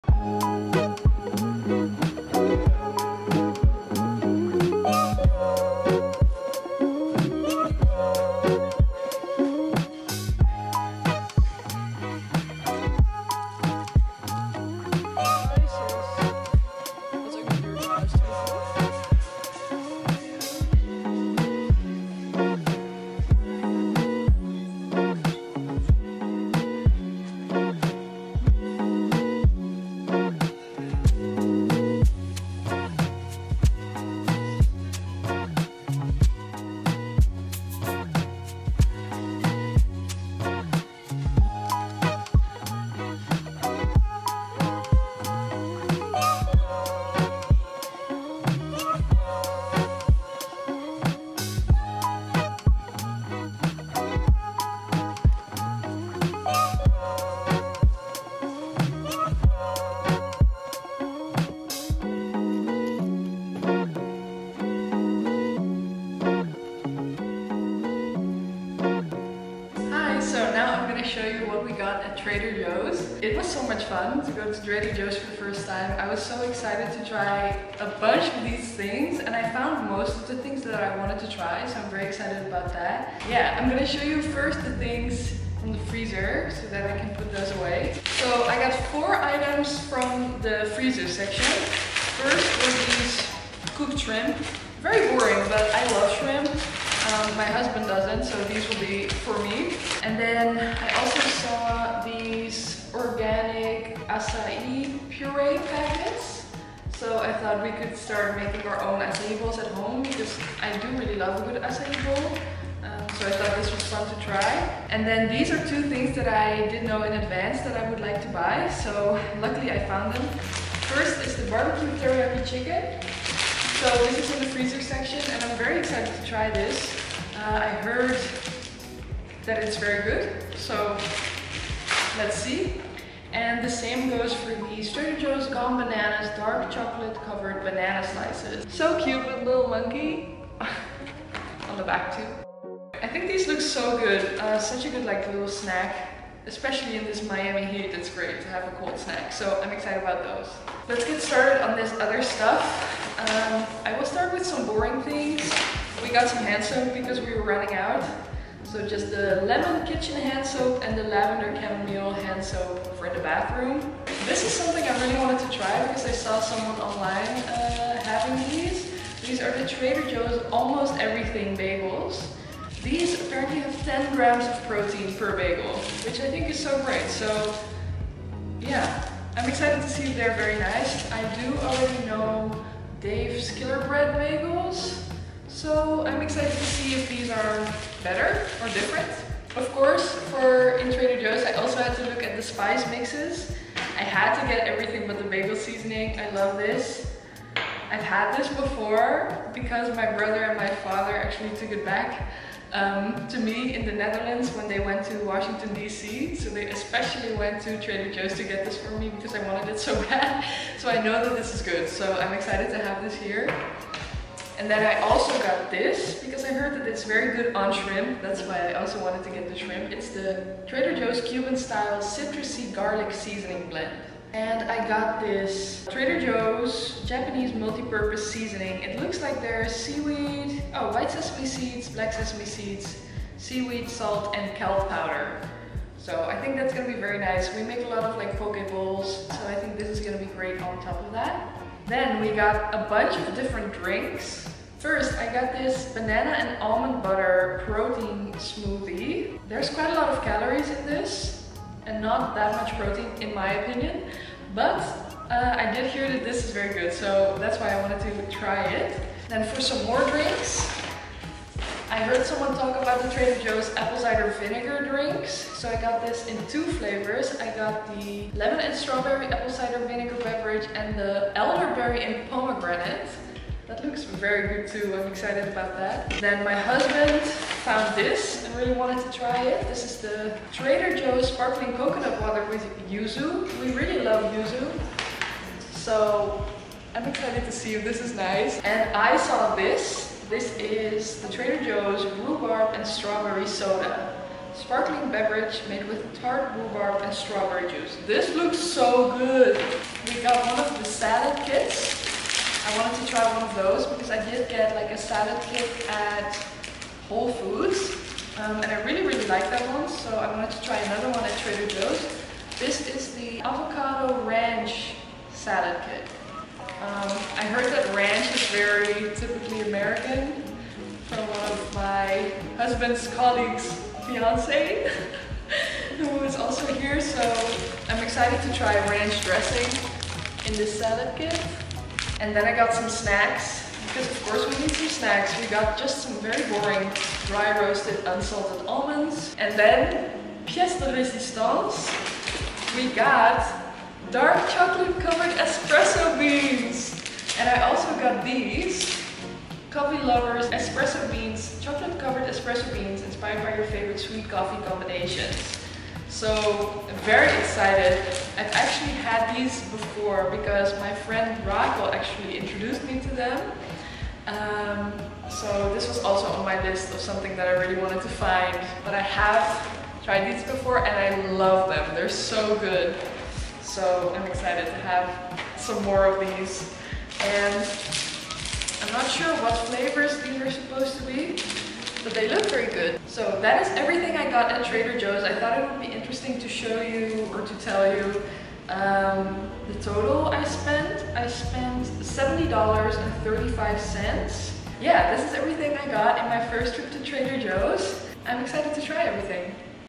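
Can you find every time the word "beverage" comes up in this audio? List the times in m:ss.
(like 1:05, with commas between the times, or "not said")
4:30, 4:55.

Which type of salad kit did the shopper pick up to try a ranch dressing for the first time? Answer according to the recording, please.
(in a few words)
Avocado ranch.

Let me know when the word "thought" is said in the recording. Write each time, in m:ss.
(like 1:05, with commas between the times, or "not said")
1:47, 1:53, 6:25.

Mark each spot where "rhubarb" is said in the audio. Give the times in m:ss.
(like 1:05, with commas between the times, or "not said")
4:52, 4:56.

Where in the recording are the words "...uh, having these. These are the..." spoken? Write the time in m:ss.
2:47.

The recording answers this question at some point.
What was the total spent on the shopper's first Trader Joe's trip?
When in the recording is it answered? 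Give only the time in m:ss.
6:31.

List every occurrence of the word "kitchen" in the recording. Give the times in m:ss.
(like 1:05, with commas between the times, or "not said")
2:39.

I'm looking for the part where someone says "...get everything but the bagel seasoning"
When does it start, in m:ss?
3:14.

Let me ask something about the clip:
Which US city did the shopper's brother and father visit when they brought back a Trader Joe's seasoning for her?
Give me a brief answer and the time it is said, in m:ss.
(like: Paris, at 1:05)
Washington DC, at 3:25.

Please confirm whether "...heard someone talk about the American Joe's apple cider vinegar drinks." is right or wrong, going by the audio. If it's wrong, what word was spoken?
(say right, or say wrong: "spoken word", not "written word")
wrong: "Trader", not "American".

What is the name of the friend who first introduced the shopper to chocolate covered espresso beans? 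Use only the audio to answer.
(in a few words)
Raquel.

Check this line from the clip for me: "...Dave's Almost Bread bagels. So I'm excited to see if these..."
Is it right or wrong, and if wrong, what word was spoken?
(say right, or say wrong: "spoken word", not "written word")
wrong: "Killer", not "Almost".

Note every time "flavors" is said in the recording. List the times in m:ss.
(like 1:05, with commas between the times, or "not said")
4:26, 6:19.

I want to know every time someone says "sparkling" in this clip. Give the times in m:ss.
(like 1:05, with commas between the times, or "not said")
4:41, 4:54.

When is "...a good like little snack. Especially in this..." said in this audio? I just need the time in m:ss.
2:24.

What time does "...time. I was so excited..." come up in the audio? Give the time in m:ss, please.
1:15.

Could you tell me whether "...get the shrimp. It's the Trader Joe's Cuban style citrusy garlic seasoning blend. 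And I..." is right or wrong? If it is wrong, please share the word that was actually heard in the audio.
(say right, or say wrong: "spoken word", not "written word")
right.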